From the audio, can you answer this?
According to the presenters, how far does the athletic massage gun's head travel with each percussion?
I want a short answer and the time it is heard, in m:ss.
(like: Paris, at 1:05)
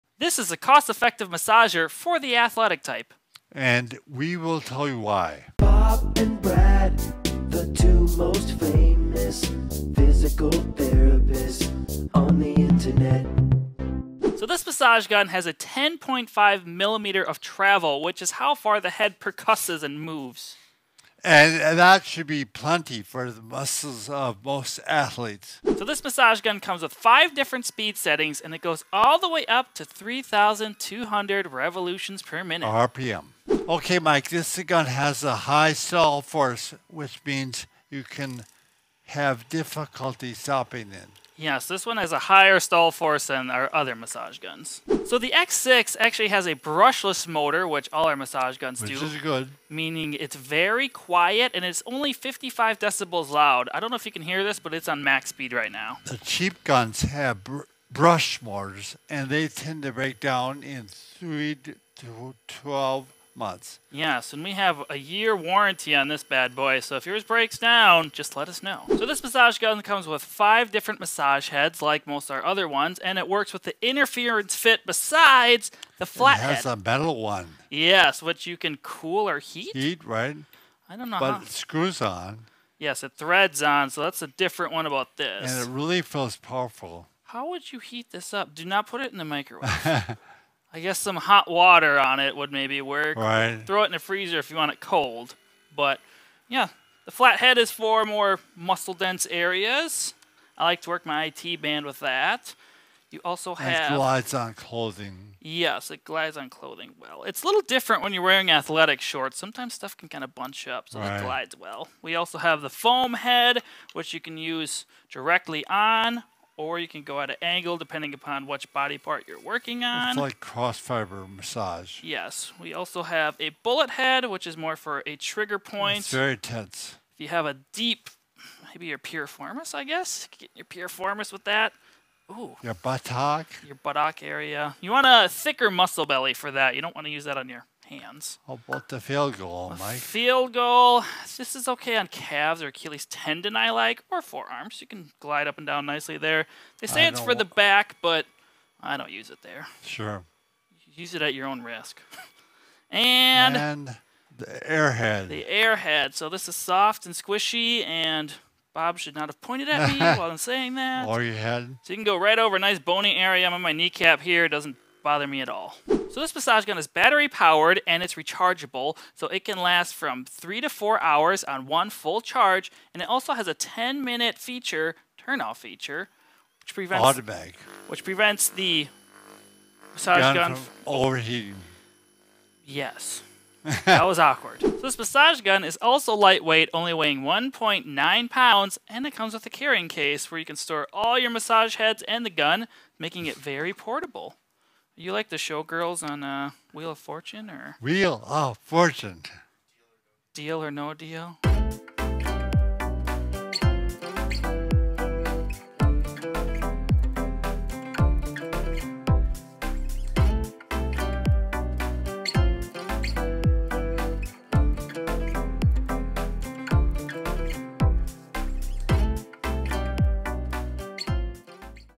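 10.5 millimeters, at 0:15.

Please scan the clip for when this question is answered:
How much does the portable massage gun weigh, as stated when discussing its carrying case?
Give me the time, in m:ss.
3:07.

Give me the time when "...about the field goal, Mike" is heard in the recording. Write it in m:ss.
2:18.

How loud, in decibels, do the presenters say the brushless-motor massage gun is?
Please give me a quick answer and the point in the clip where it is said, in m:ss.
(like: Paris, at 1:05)
55 decibels, at 0:52.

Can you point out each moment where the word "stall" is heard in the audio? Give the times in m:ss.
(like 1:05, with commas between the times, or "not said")
0:35, 0:42.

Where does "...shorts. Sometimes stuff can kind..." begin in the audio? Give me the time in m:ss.
1:49.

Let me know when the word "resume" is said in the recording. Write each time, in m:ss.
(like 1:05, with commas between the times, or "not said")
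not said.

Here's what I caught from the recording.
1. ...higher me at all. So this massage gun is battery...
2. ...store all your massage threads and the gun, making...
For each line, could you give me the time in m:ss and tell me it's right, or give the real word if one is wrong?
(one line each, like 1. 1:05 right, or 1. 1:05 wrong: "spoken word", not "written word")
1. 2:45 wrong: "bother", not "higher"
2. 3:10 wrong: "heads", not "threads".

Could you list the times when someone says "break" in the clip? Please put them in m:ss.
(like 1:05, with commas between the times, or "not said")
0:59, 1:07.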